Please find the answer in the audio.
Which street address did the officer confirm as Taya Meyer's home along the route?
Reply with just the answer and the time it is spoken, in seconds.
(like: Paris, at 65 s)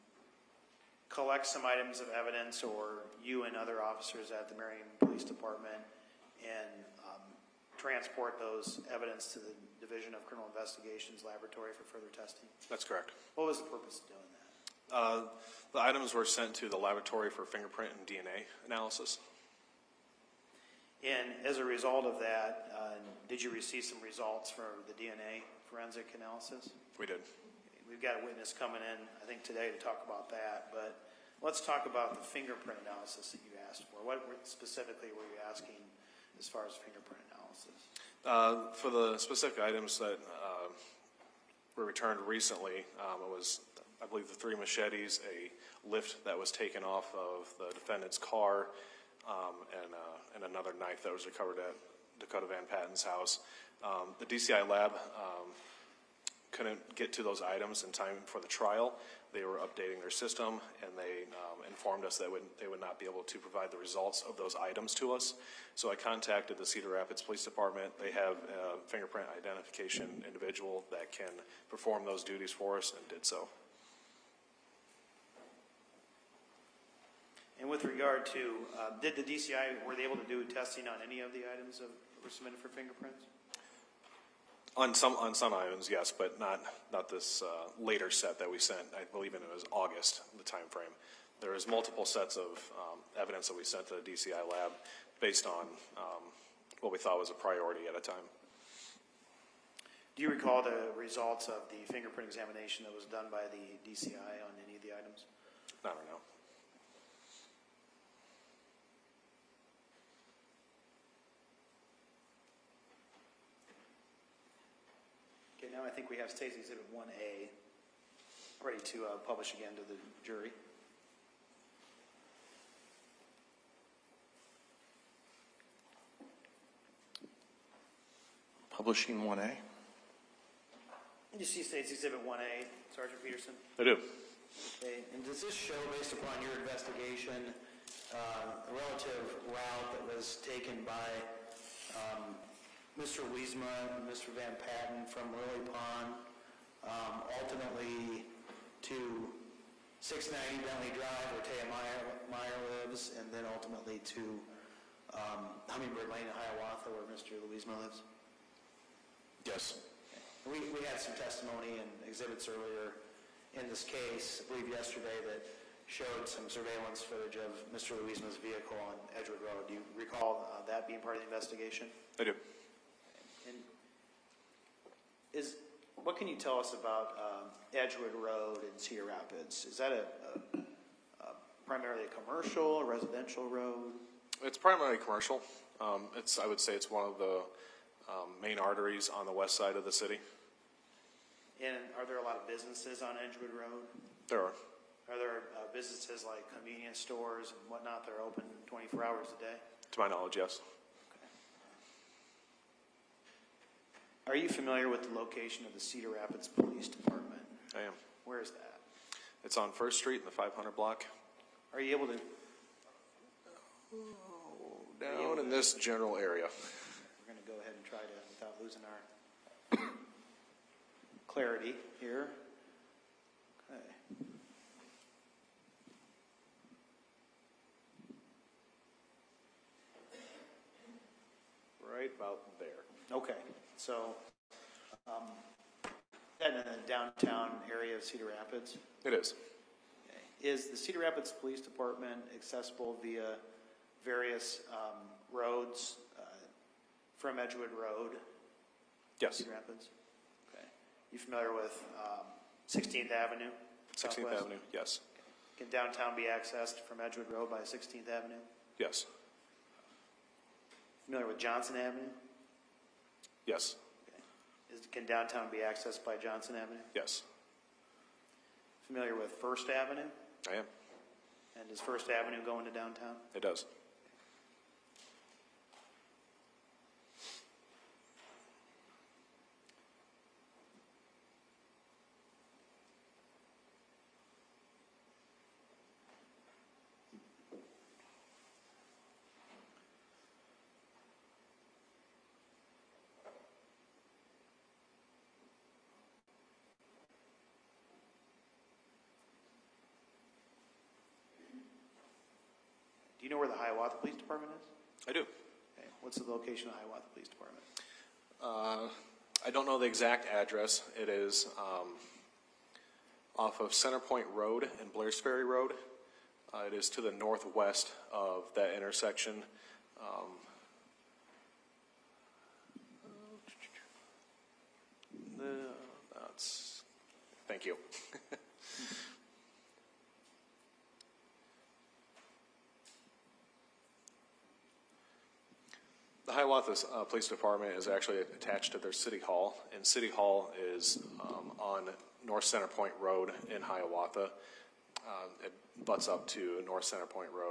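690 Bentley Drive, at 150 s.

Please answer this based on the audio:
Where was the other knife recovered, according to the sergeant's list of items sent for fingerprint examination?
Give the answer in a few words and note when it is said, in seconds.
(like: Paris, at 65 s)
Dakota Van Patten's house, at 52 s.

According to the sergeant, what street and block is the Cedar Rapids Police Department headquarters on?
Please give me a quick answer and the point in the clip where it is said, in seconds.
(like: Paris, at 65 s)
First Street, 500 block, at 209 s.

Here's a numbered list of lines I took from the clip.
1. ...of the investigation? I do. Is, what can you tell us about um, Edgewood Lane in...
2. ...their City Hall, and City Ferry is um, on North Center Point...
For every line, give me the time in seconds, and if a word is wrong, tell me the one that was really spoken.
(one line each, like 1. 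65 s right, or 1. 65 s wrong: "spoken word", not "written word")
1. 171 s wrong: "Road", not "Lane"
2. 338 s wrong: "Hall", not "Ferry".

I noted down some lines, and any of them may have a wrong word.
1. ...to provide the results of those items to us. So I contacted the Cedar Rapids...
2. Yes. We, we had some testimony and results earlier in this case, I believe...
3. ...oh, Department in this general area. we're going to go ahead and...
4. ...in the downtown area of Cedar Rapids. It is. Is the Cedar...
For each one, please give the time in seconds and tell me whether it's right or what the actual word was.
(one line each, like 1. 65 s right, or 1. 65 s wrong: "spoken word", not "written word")
1. 63 s right
2. 159 s wrong: "exhibits", not "results"
3. 213 s wrong: "Down", not "Department"
4. 236 s right.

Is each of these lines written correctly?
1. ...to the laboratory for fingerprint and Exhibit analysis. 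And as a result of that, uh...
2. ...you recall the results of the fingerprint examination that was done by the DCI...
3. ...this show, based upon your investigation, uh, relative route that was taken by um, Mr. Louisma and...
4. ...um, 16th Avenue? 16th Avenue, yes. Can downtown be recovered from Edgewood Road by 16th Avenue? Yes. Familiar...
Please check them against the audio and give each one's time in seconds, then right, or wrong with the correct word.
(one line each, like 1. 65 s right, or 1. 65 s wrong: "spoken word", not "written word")
1. 16 s wrong: "DNA", not "Exhibit"
2. 100 s right
3. 135 s right
4. 252 s wrong: "accessed", not "recovered".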